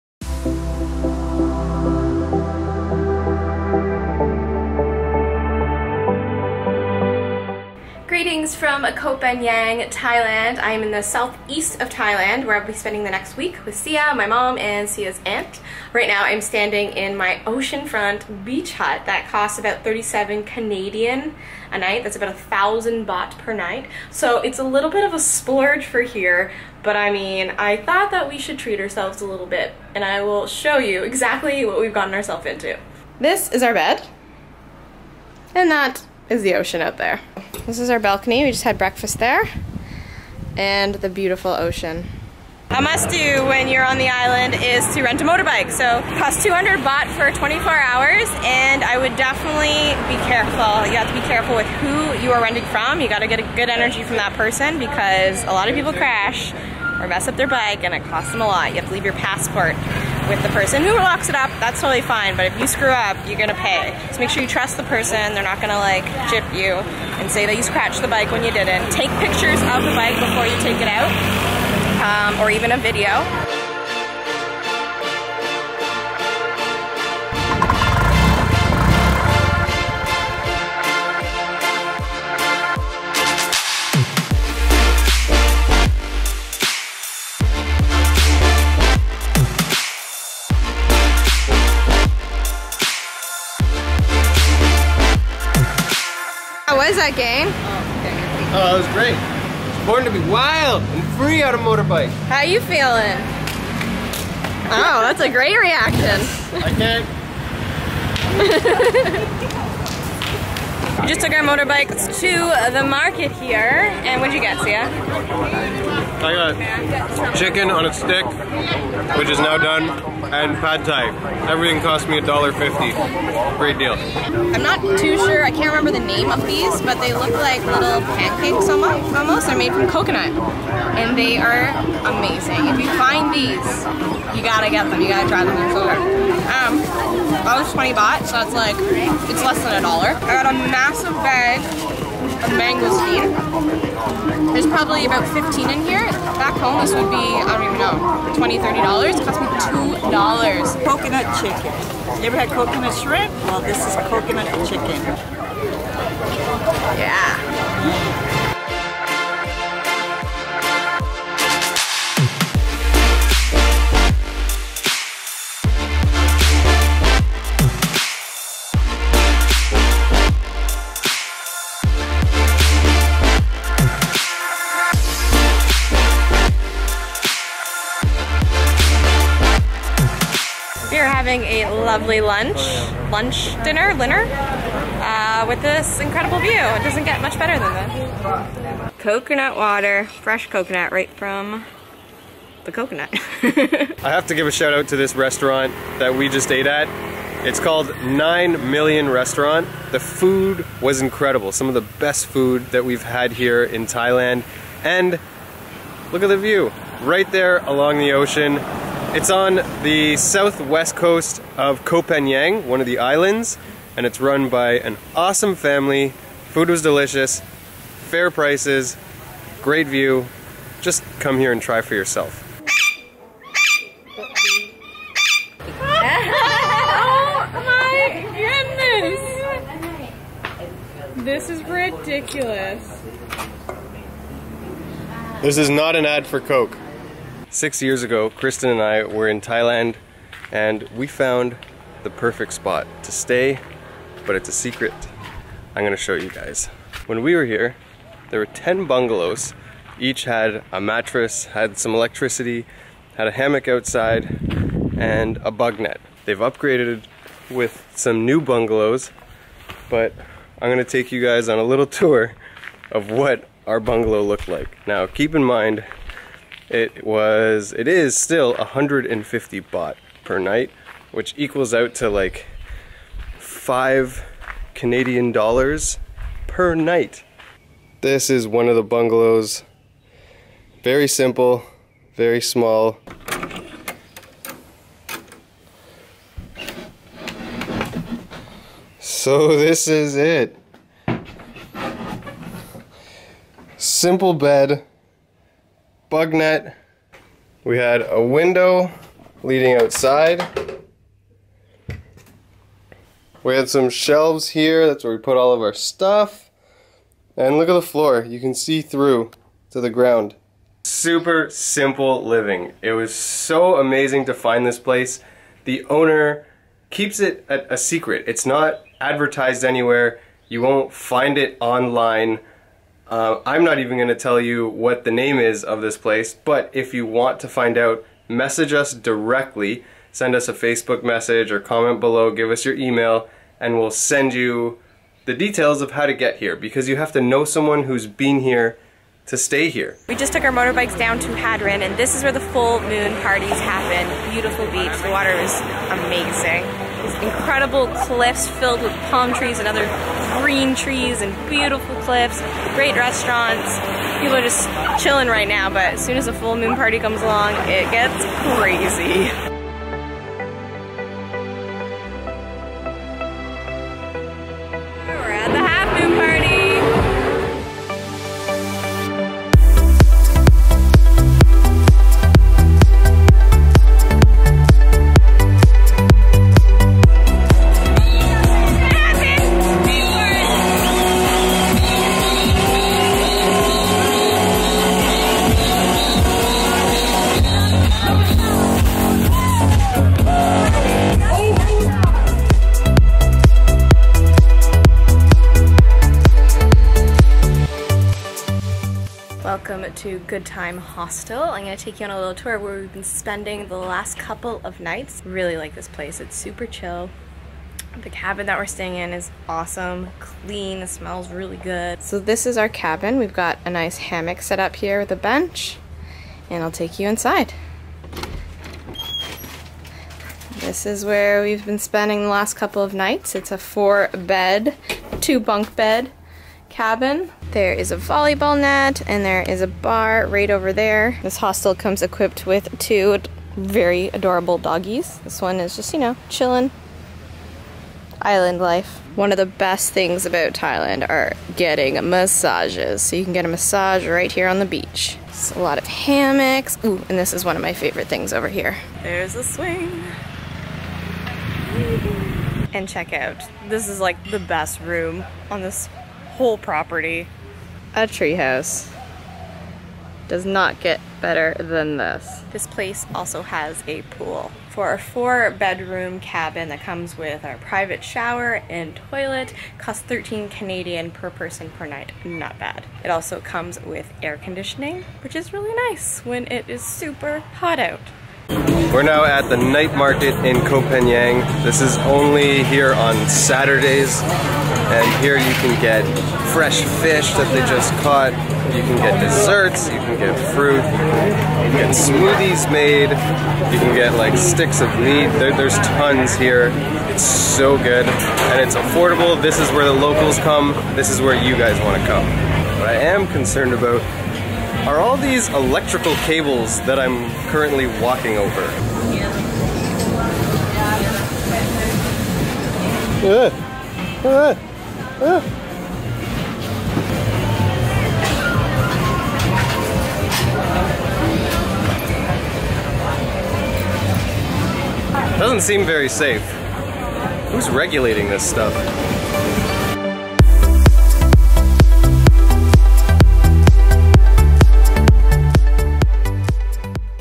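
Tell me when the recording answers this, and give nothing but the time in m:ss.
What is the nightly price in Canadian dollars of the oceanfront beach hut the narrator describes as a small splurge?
0:19.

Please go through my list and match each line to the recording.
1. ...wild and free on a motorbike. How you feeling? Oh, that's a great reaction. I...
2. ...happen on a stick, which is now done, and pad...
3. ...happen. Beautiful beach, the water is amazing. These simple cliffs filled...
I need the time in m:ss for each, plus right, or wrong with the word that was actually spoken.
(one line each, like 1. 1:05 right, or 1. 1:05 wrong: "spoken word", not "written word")
1. 1:40 right
2. 1:57 wrong: "chicken", not "happen"
3. 5:43 wrong: "incredible", not "simple".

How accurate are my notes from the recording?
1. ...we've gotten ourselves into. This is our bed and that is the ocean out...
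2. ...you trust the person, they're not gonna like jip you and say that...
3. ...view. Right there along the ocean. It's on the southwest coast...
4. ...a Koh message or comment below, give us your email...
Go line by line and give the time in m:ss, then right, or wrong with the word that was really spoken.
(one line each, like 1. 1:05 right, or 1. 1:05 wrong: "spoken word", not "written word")
1. 0:31 right
2. 1:04 right
3. 3:26 right
4. 5:30 wrong: "Facebook", not "Koh".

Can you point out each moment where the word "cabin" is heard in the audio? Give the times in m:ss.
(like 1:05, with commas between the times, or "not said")
6:48, 6:52, 7:06, 7:46.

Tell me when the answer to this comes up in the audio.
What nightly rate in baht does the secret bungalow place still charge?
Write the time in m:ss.
4:28.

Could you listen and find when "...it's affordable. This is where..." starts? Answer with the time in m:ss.
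8:18.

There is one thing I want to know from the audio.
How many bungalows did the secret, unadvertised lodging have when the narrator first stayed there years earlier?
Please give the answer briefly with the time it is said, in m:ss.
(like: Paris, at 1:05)
10, at 4:08.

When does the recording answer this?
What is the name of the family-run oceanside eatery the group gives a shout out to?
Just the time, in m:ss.
3:18.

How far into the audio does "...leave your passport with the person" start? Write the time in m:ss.
0:58.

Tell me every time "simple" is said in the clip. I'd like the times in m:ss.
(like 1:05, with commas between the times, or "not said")
4:41, 4:53, 5:11.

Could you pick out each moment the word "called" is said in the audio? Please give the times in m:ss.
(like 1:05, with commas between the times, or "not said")
3:17.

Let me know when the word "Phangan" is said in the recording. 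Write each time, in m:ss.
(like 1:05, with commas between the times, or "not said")
0:09, 3:32, 8:00.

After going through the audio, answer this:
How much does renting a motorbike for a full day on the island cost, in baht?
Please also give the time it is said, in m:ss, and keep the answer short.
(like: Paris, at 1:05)
200 baht, at 0:46.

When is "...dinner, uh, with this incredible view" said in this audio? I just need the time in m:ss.
3:03.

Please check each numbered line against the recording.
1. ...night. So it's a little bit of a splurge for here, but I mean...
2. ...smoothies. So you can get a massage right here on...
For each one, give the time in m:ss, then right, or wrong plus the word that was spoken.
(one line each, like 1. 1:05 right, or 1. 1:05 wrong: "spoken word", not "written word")
1. 0:23 right
2. 7:22 wrong: "massages", not "smoothies".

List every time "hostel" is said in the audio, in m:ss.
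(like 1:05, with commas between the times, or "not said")
6:40, 7:11.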